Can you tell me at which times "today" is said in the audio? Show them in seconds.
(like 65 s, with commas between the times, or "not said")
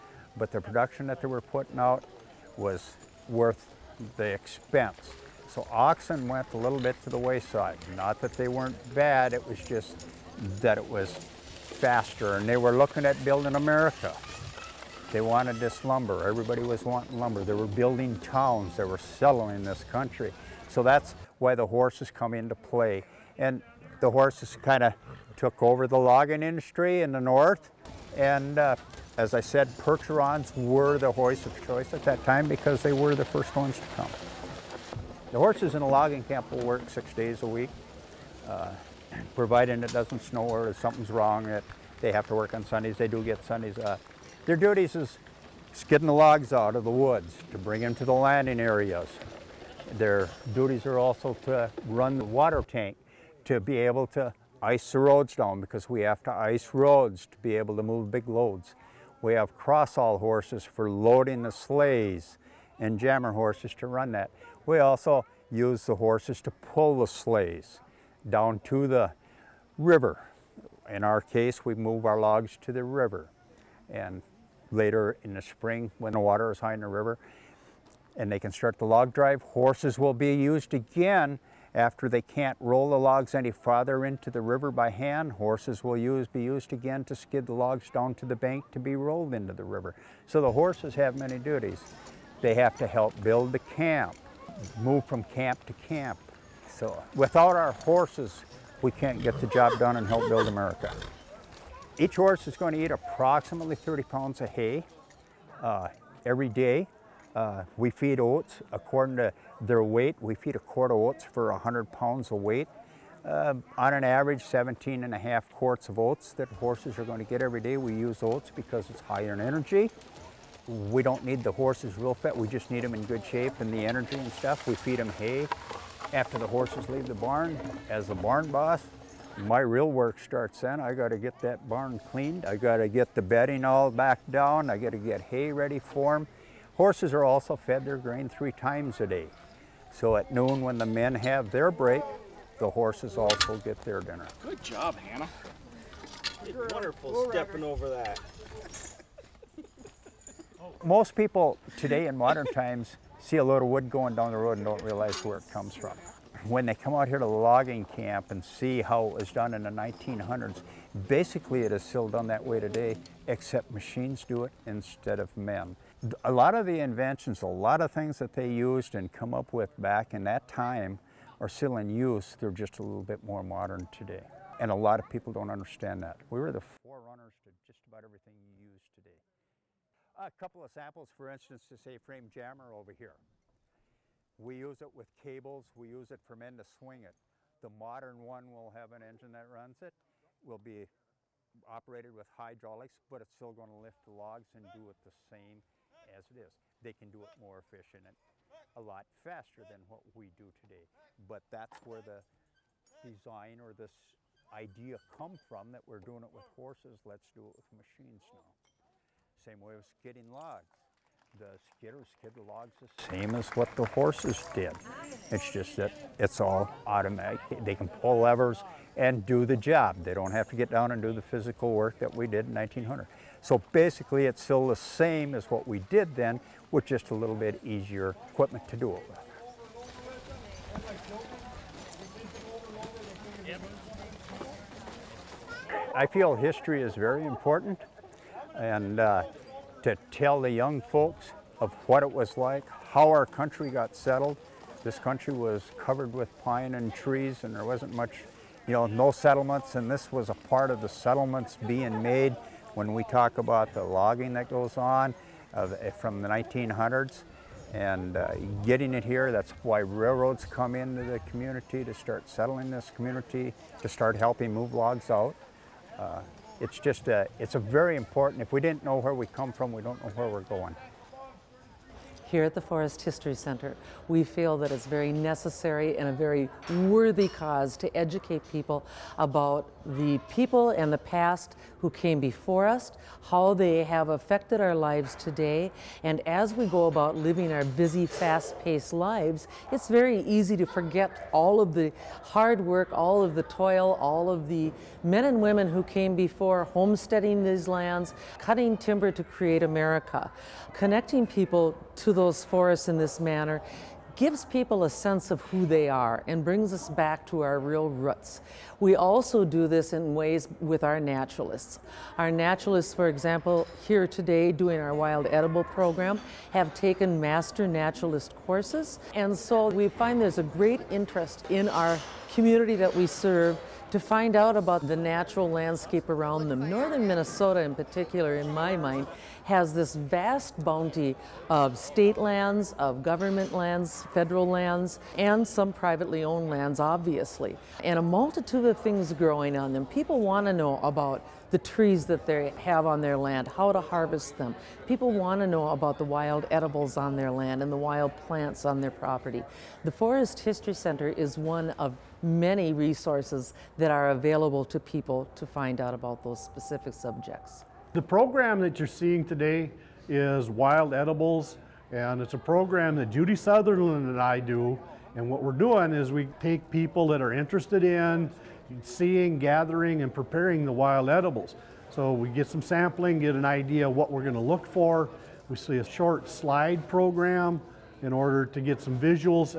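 151 s, 162 s, 173 s, 178 s, 200 s, 285 s, 314 s, 359 s.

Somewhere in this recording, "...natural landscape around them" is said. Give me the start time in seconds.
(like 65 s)
324 s.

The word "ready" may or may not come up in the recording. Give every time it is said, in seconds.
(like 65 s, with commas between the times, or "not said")
135 s.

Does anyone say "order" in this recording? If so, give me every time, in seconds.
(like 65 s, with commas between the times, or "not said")
378 s.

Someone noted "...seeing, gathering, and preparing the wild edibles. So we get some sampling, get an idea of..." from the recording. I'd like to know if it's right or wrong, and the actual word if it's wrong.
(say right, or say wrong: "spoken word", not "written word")
right.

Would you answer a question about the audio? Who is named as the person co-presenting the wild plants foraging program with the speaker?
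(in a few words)
Judy Sutherland.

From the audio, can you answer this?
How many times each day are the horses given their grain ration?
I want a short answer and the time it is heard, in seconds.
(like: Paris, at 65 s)
3, at 138 s.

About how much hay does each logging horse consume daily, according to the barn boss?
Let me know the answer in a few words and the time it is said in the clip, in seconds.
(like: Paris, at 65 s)
30 pounds, at 103 s.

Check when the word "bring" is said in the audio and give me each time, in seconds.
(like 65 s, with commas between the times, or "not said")
47 s, 306 s.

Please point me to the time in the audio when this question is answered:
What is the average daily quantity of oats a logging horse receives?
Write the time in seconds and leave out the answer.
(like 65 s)
114 s.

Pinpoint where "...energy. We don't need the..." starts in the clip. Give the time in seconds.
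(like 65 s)
119 s.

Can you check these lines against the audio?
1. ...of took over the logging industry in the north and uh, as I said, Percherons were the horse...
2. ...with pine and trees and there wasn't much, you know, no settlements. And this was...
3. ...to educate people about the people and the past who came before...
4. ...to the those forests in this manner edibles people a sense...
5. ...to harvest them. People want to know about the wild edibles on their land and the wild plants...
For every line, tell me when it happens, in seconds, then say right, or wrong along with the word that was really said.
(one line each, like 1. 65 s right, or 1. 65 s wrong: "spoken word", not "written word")
1. 24 s right
2. 246 s right
3. 277 s right
4. 301 s wrong: "gives", not "edibles"
5. 343 s right.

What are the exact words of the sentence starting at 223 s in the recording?
So basically it's still the same as what we did then with just a little bit easier equipment to do it with.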